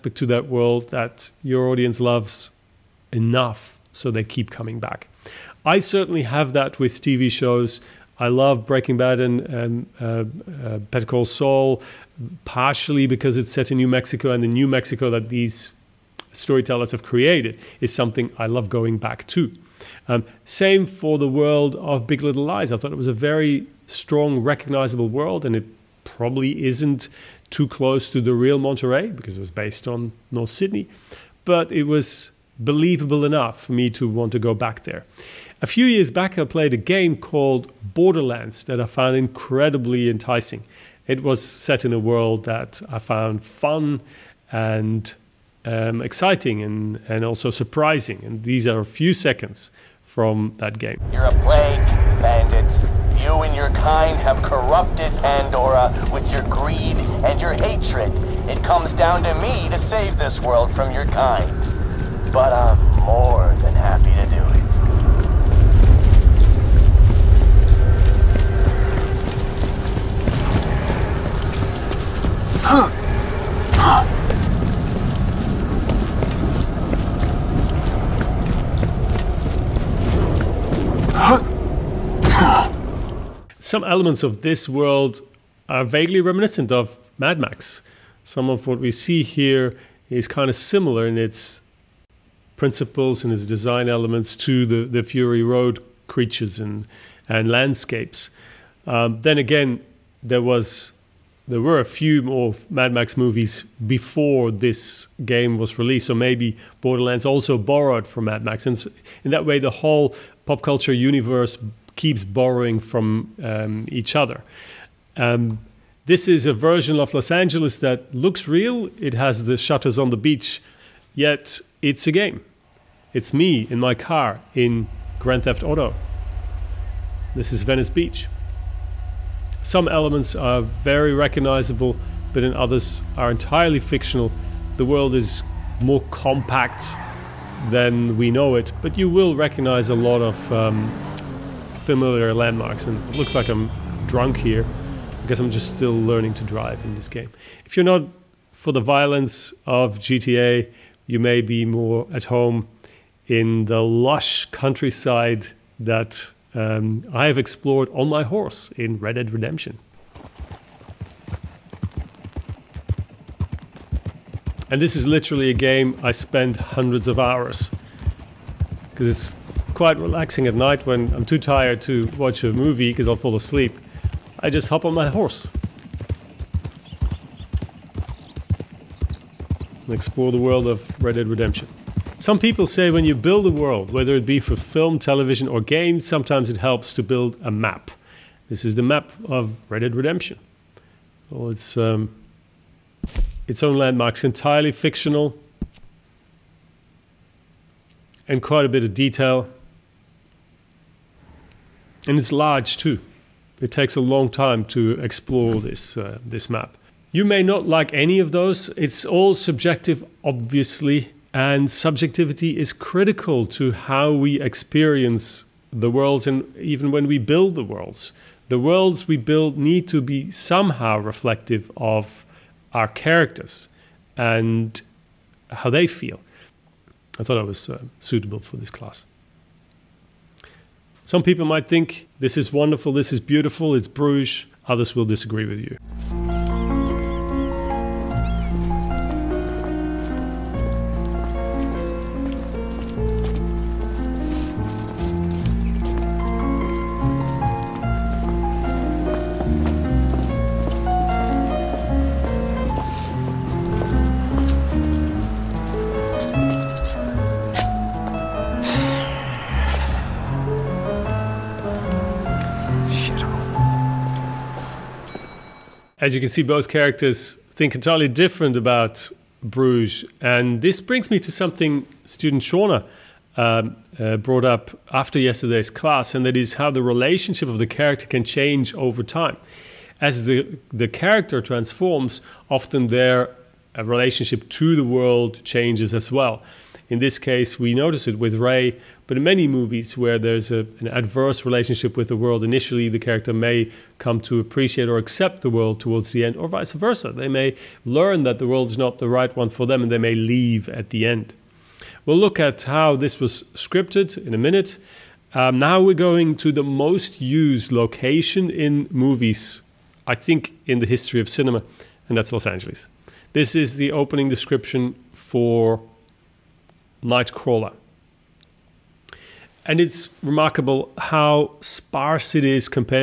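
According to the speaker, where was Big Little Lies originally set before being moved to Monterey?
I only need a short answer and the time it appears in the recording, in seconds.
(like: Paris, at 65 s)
North Sydney, at 30 s.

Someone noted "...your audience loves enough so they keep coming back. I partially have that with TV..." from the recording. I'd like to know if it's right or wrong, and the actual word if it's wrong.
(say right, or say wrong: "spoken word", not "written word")
wrong: "certainly", not "partially".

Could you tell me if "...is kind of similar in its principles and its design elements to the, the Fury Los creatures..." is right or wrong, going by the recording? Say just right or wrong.
wrong.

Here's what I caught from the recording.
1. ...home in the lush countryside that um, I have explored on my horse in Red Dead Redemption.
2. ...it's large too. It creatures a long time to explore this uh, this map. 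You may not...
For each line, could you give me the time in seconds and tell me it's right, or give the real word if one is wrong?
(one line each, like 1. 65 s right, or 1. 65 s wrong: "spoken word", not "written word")
1. 152 s right
2. 202 s wrong: "takes", not "creatures".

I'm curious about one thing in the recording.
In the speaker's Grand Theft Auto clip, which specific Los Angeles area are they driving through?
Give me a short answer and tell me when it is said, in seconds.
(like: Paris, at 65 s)
Venice Beach, at 127 s.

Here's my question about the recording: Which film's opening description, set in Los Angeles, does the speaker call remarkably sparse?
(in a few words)
Nightcrawler.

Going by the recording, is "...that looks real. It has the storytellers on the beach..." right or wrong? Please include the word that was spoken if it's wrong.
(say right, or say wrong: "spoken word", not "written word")
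wrong: "shutters", not "storytellers".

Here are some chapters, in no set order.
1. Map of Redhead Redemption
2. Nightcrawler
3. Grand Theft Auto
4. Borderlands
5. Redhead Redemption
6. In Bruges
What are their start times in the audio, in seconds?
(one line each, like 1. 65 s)
1. 182 s
2. 304 s
3. 111 s
4. 35 s
5. 146 s
6. 230 s.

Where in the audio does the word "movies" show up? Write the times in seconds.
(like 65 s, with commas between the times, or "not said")
103 s, 172 s, 289 s, 308 s.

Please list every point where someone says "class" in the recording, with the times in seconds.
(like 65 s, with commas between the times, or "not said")
228 s, 275 s.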